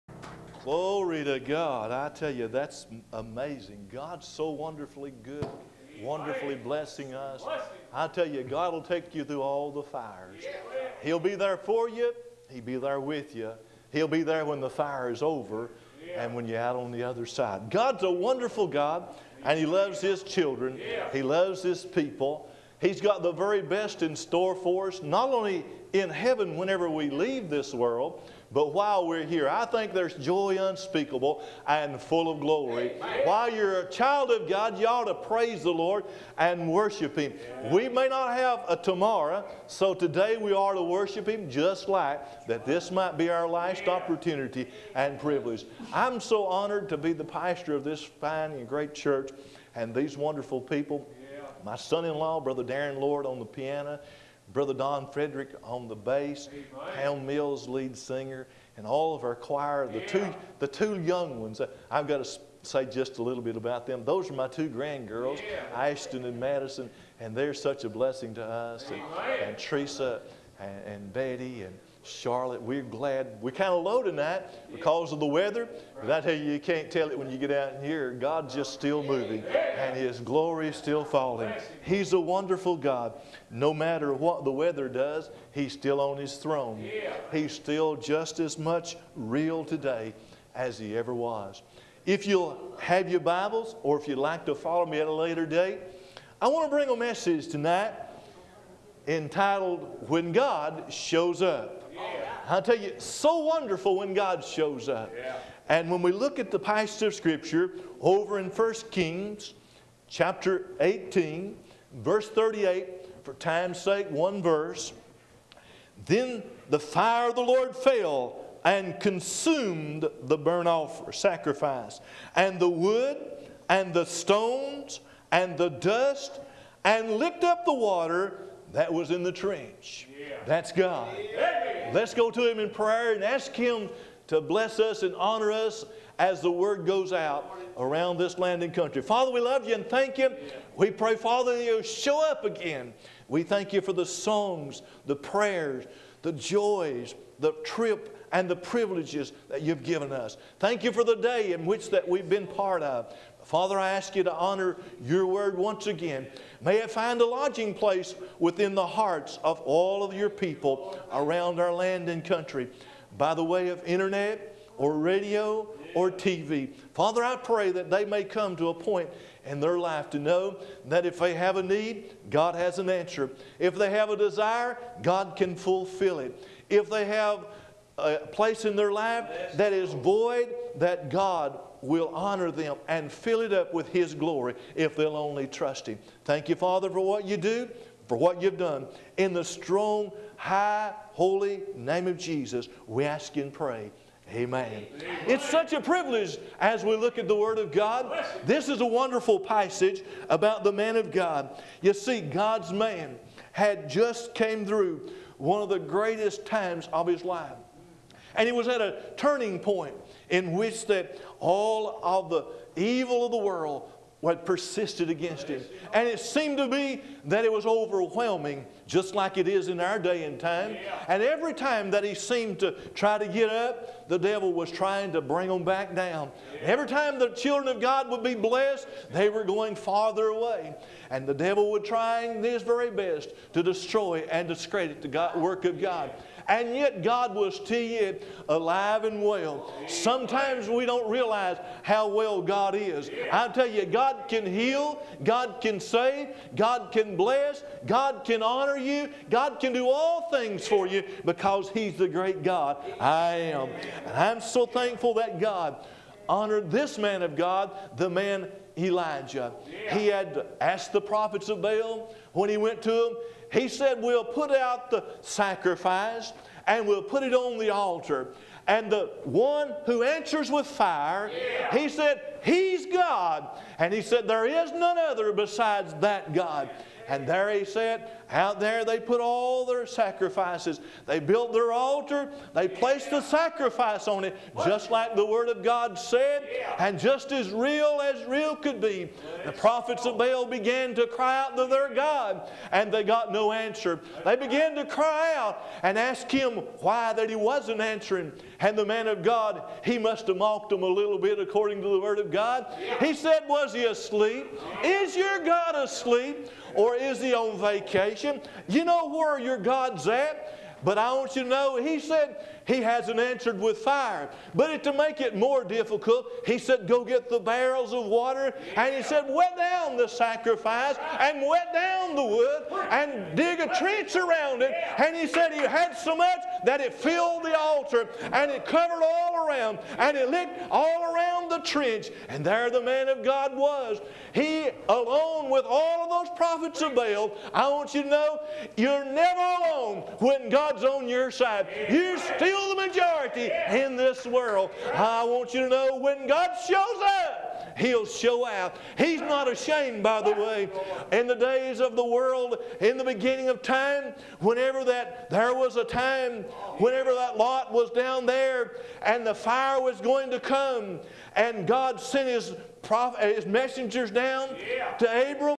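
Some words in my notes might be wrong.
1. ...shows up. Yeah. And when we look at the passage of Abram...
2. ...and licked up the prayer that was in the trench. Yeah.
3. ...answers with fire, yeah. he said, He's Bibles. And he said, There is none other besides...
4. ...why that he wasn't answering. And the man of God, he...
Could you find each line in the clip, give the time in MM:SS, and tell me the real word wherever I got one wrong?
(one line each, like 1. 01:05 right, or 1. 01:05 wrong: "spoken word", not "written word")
1. 01:44 wrong: "Scripture", not "Abram"
2. 02:06 wrong: "water", not "prayer"
3. 04:30 wrong: "God", not "Bibles"
4. 04:56 right.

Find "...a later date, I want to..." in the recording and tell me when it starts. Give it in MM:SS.
01:35.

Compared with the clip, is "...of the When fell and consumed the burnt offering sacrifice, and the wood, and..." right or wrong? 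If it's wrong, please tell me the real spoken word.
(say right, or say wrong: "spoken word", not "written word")
wrong: "Lord", not "When".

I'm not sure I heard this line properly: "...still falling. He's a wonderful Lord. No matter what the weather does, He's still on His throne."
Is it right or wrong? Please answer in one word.
wrong.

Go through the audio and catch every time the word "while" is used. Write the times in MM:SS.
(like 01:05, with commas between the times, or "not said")
00:28, 00:33.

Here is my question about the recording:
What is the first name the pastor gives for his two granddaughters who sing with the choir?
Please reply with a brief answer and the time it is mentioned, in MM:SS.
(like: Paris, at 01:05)
Ashton, at 01:05.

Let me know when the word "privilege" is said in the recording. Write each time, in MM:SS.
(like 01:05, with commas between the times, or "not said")
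00:45, 02:28, 03:15.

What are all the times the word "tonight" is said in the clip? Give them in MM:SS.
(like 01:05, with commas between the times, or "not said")
01:14, 01:37.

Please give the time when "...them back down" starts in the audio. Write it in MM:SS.
03:45.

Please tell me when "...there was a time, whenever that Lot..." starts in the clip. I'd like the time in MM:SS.
05:55.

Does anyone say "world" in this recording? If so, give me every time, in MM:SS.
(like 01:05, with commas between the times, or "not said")
00:27, 03:33, 05:44, 05:52.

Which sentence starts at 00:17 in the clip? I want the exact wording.
God's a wonderful God, and He loves His children, He loves His people.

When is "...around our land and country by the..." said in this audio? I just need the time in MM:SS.
02:41.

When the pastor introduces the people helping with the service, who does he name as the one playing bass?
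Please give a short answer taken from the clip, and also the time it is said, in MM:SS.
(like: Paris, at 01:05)
Don Frederick, at 00:54.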